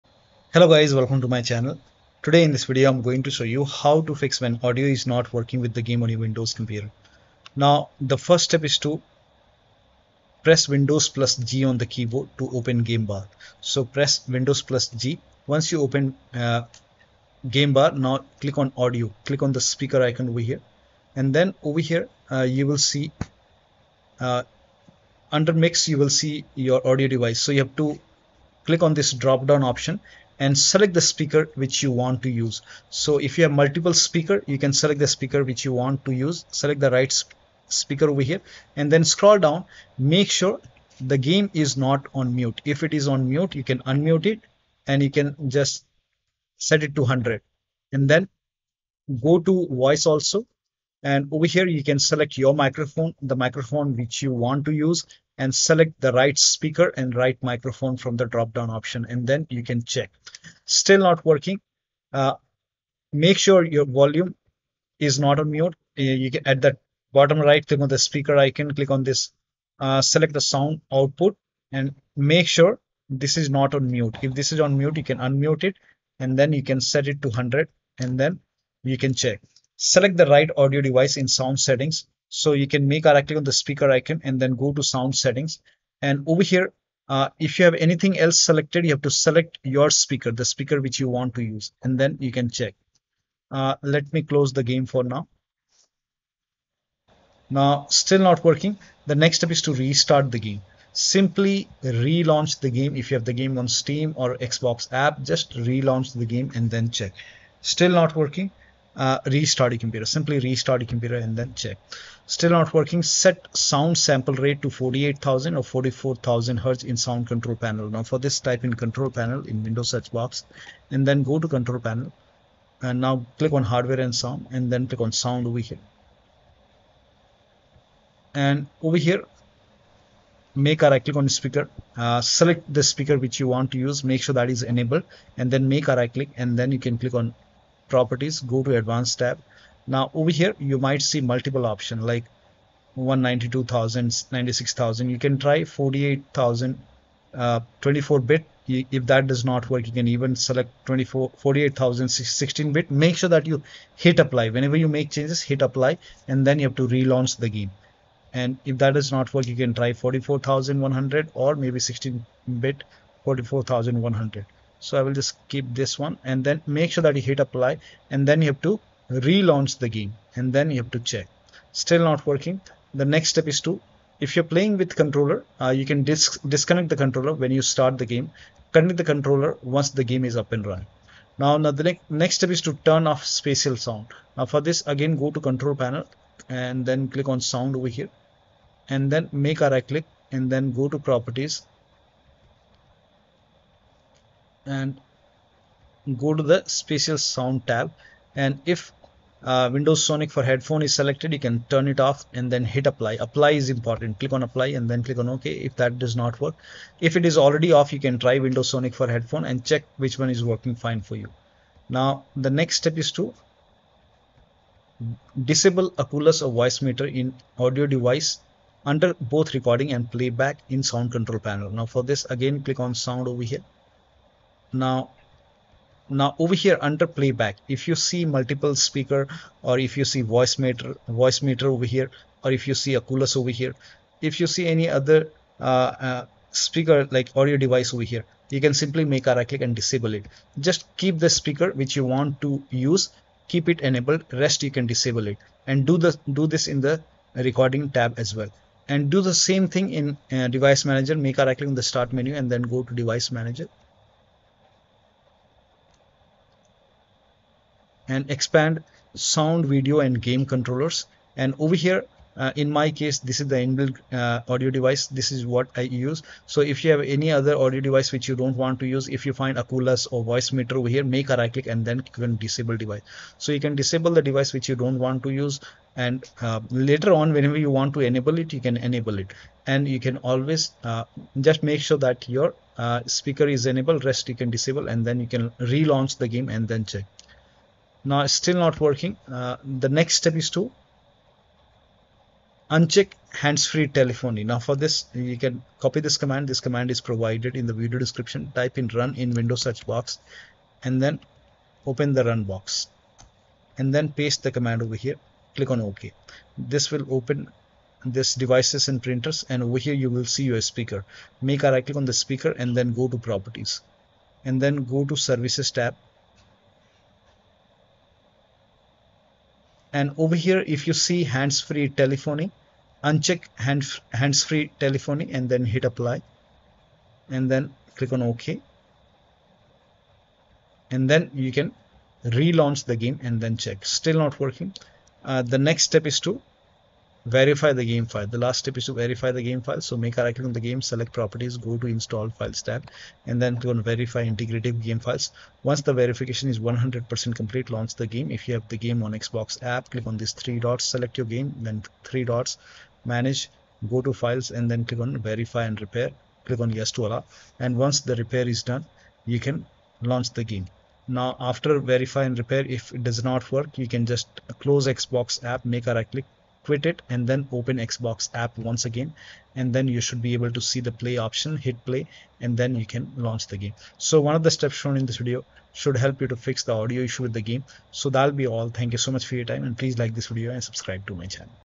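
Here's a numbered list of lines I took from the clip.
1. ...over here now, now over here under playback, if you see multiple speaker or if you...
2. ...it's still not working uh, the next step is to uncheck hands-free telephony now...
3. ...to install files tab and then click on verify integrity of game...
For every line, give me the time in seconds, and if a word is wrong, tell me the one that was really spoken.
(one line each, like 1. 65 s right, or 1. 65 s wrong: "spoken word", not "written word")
1. 223 s right
2. 288 s right
3. 341 s right.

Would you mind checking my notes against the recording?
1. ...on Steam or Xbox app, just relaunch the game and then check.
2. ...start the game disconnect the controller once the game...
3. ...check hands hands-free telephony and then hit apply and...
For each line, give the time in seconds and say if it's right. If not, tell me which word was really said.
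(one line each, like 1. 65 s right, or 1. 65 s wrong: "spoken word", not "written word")
1. 103 s right
2. 177 s wrong: "connect", not "disconnect"
3. 323 s wrong: "uncheck", not "check".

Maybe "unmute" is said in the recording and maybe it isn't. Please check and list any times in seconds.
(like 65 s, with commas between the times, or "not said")
43 s, 75 s.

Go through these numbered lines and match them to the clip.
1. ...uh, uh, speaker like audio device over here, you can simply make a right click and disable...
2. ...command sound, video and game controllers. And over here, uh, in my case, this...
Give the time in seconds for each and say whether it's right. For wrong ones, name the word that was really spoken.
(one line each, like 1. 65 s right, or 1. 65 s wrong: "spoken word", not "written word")
1. 235 s right
2. 258 s wrong: "expand", not "command".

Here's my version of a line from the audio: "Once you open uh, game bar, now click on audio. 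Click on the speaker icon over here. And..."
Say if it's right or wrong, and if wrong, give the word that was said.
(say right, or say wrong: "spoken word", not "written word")
right.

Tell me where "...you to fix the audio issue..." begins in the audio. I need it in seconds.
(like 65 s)
376 s.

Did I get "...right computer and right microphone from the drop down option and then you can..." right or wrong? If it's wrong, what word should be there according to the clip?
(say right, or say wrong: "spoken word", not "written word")
wrong: "speaker", not "computer".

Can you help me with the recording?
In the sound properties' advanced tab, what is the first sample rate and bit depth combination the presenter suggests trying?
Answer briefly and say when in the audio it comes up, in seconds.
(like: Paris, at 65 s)
48,000, 24 bit, at 145 s.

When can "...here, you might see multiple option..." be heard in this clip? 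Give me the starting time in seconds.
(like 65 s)
140 s.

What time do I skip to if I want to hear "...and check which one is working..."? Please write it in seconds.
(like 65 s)
209 s.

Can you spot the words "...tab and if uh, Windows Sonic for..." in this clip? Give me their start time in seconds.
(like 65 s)
197 s.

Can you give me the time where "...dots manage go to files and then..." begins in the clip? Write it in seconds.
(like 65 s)
352 s.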